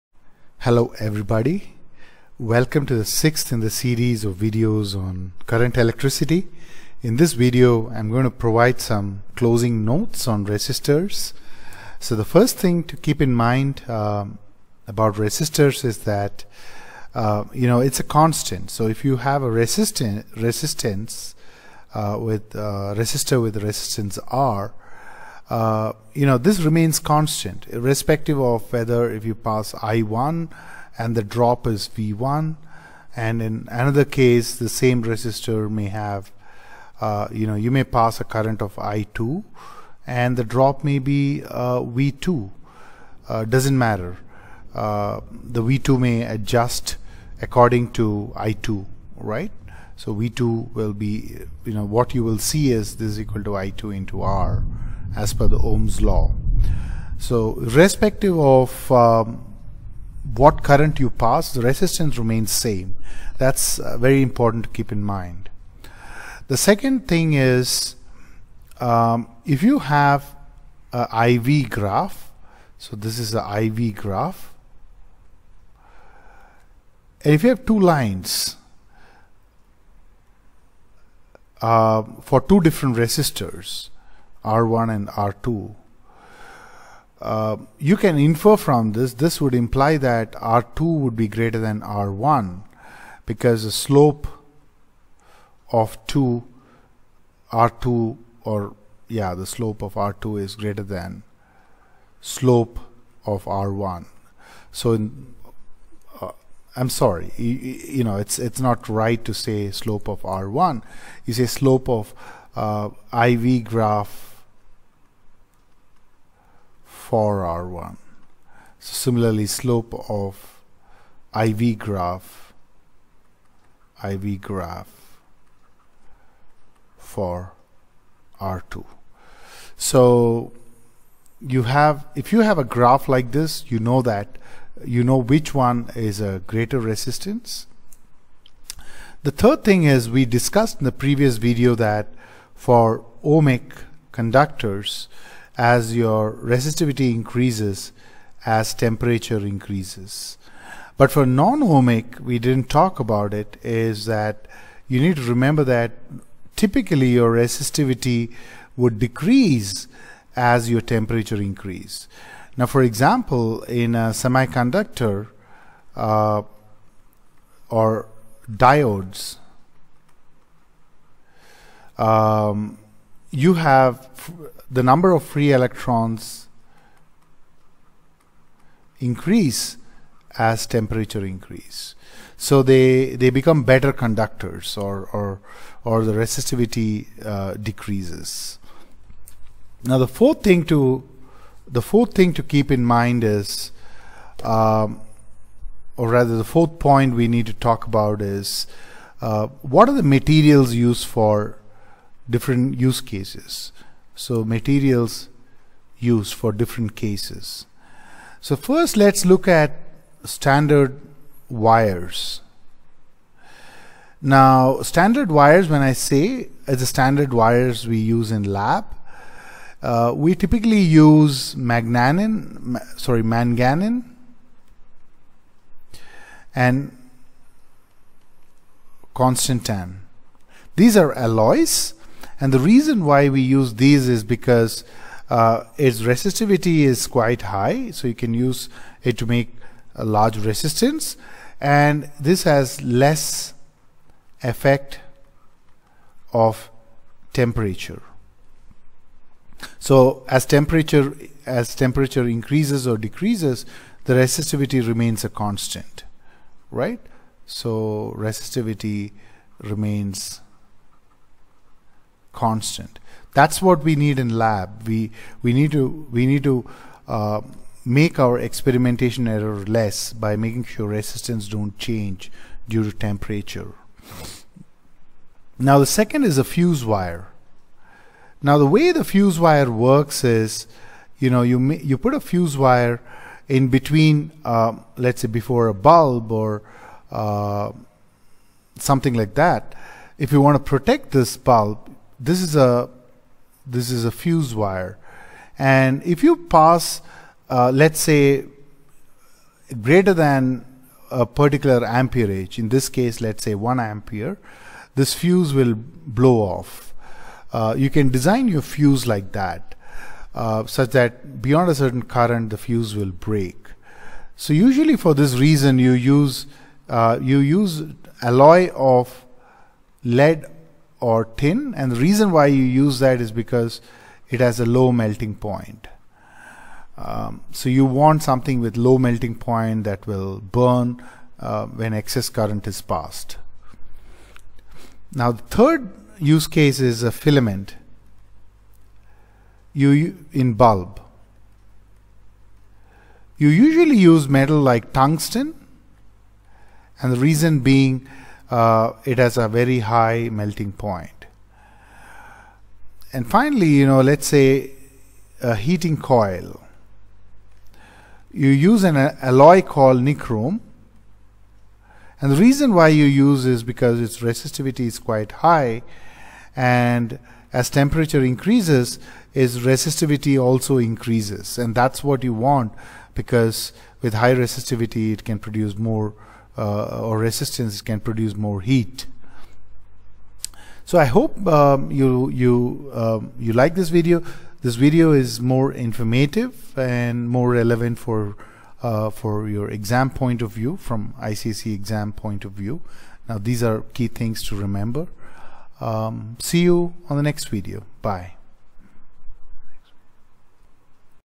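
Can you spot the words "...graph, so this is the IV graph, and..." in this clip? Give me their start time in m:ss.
1:11.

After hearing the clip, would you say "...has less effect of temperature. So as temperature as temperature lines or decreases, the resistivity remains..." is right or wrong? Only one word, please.
wrong.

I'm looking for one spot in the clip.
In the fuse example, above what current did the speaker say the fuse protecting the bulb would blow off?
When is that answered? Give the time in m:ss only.
5:03.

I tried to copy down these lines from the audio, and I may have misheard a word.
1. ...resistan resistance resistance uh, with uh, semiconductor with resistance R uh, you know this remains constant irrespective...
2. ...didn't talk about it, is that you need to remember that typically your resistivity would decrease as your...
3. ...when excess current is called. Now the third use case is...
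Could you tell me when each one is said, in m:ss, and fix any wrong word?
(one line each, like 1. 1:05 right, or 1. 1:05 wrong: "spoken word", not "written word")
1. 0:19 wrong: "resistor", not "semiconductor"
2. 2:32 right
3. 5:31 wrong: "passed", not "called".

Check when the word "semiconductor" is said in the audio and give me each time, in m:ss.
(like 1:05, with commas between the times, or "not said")
2:44.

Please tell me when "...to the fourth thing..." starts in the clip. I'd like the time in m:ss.
3:10.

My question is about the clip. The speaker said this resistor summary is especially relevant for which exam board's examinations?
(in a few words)
ICSE.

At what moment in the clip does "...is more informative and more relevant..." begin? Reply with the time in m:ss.
6:25.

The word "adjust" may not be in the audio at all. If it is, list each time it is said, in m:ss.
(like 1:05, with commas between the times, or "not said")
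0:46.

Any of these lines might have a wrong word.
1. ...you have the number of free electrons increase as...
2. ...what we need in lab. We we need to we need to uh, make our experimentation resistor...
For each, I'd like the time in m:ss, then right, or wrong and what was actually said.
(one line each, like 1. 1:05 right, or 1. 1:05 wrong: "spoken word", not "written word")
1. 2:53 right
2. 4:23 wrong: "error", not "resistor".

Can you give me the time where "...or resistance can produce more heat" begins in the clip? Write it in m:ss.
6:17.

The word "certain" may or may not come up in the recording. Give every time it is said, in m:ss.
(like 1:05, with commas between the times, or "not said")
5:11.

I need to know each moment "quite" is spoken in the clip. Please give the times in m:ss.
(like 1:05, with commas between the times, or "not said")
3:57, 6:04.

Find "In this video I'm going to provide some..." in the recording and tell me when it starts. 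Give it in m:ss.
0:07.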